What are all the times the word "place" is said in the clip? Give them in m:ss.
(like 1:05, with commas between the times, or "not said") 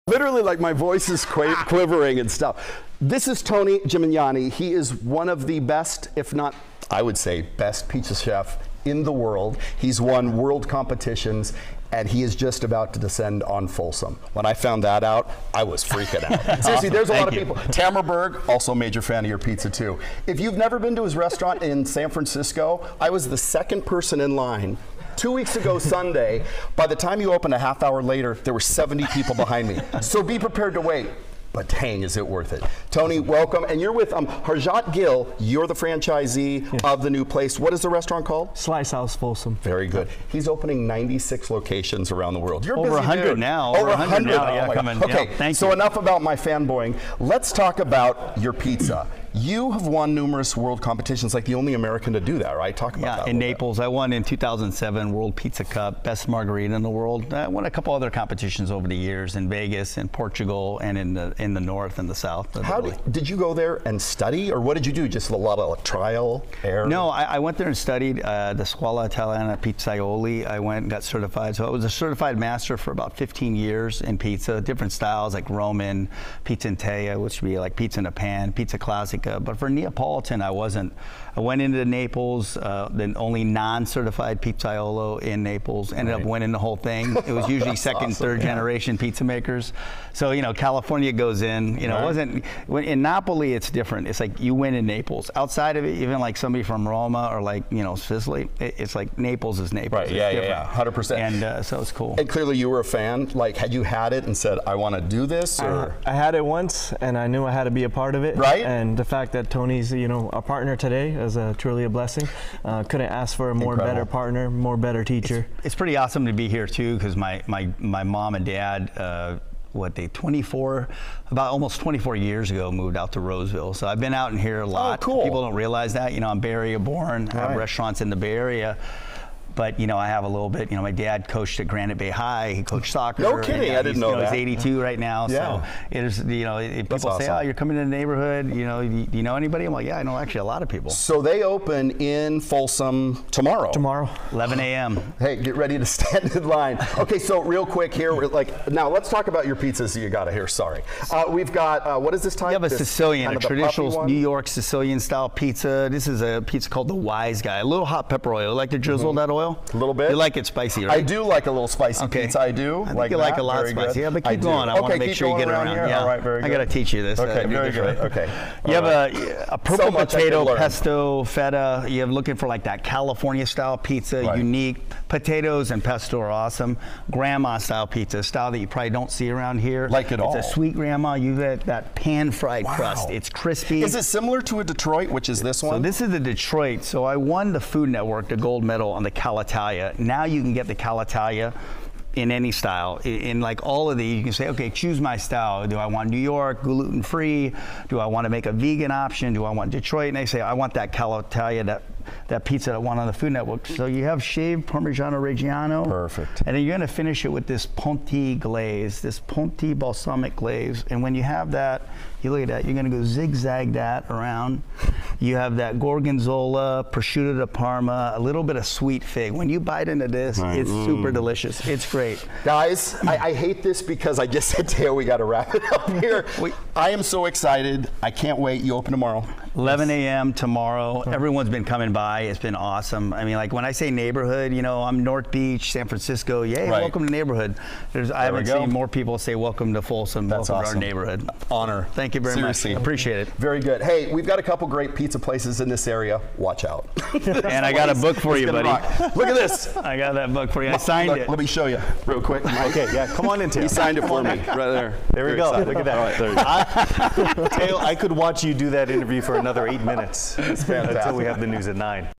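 0:37, 4:05.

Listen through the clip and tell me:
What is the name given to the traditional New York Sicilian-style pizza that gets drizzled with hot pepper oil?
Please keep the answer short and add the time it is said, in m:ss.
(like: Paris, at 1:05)
Wise Guy, at 2:36.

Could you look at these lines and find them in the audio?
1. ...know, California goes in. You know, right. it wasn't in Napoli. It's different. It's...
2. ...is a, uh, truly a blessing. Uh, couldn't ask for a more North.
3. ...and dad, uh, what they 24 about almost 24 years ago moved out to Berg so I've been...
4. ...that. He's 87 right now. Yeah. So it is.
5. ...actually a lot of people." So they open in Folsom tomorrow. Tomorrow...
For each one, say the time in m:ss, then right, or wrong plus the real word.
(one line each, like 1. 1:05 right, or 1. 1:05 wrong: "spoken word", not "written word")
1. 1:30 right
2. 1:51 wrong: "Incredible", not "North"
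3. 1:58 wrong: "Roseville", not "Berg"
4. 2:14 wrong: "82", not "87"
5. 2:20 right.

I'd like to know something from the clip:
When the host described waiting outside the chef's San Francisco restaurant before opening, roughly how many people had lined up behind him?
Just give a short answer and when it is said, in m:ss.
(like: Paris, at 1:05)
70, at 0:28.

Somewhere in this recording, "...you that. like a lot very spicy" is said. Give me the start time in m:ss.
2:43.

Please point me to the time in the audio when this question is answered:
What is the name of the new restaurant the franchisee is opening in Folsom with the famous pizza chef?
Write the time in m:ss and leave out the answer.
0:38.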